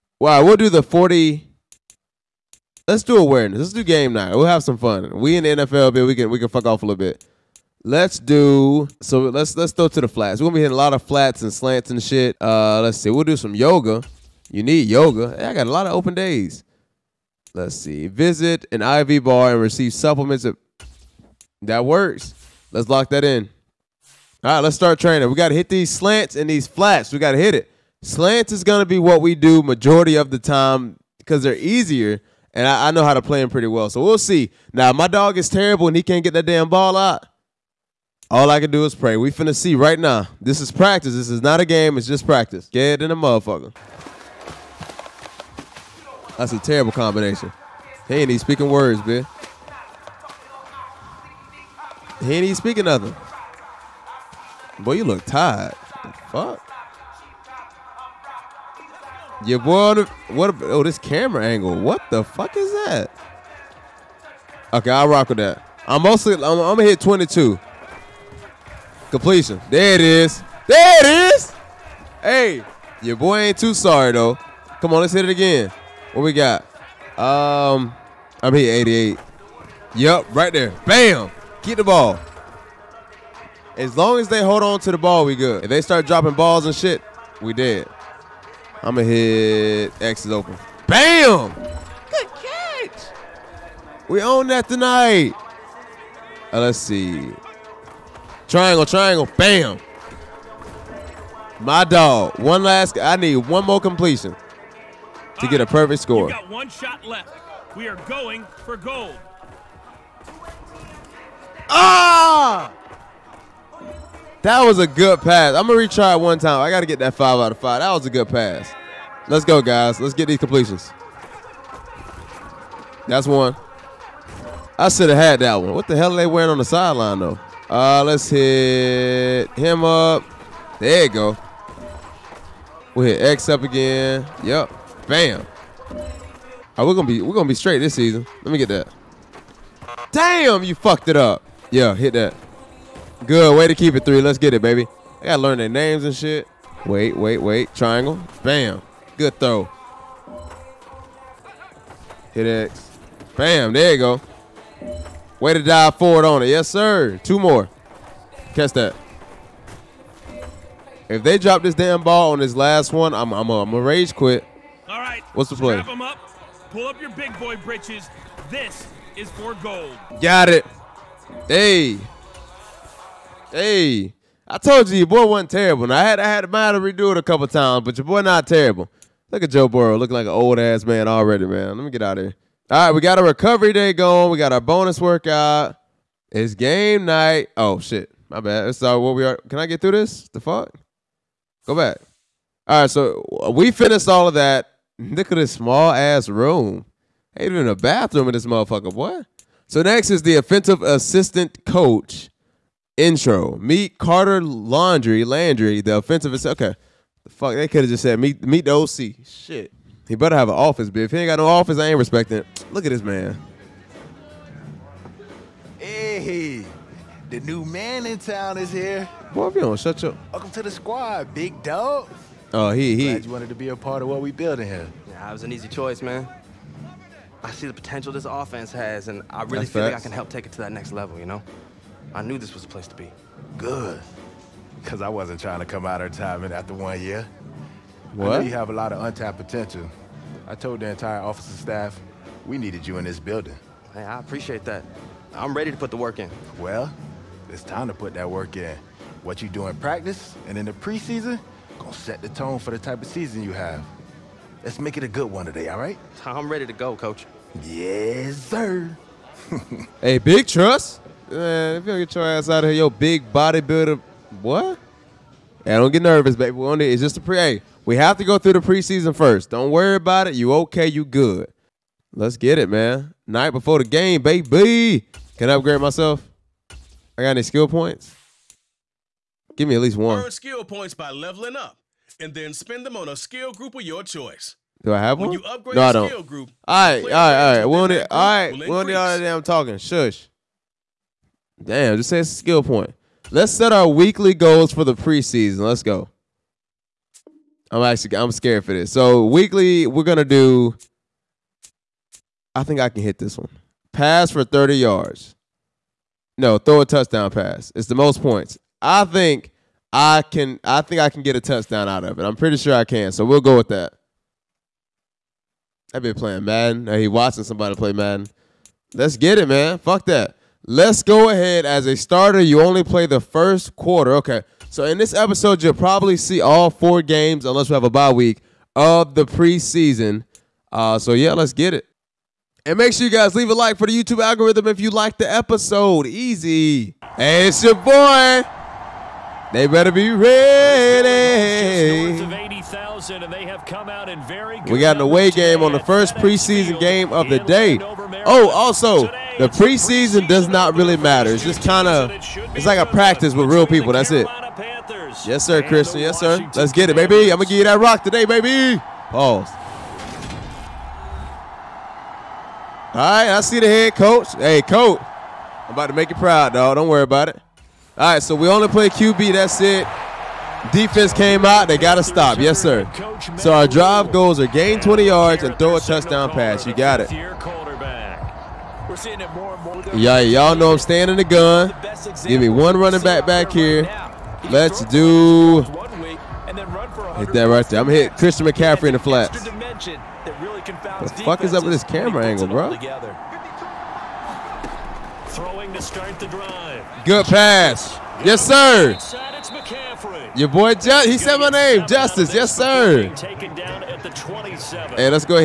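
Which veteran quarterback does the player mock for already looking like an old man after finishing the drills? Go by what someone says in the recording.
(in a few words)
Joe Burrow.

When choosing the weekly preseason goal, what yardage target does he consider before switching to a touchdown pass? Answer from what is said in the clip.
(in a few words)
30 yards.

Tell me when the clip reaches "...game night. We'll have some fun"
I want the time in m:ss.
0:03.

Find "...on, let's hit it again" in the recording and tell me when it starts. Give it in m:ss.
1:14.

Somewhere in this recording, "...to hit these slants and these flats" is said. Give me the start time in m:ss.
0:25.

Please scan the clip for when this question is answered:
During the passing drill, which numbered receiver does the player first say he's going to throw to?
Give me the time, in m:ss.
1:06.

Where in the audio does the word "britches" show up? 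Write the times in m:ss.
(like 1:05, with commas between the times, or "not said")
2:47.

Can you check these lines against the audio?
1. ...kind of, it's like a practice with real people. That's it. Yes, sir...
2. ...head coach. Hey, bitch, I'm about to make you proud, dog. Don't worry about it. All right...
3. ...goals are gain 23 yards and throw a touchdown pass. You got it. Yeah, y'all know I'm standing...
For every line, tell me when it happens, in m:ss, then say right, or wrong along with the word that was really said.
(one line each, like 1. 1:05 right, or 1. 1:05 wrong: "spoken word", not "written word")
1. 5:51 right
2. 6:03 wrong: "coach", not "bitch"
3. 6:14 wrong: "20", not "23".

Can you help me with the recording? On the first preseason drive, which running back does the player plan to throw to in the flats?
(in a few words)
Christian McCaffrey.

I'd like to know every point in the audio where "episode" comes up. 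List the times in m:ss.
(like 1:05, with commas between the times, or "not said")
5:25, 5:35.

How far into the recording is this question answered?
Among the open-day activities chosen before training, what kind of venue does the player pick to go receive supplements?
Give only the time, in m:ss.
0:18.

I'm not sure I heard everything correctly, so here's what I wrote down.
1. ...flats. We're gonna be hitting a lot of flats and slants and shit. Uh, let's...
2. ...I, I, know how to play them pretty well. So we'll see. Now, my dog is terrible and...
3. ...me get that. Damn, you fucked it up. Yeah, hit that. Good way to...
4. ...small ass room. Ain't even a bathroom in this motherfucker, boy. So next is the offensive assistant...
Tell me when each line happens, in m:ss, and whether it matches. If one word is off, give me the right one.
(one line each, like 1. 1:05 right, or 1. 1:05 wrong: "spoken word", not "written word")
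1. 0:10 right
2. 0:32 right
3. 2:18 right
4. 3:15 right.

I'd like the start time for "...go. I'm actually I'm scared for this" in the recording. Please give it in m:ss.
4:55.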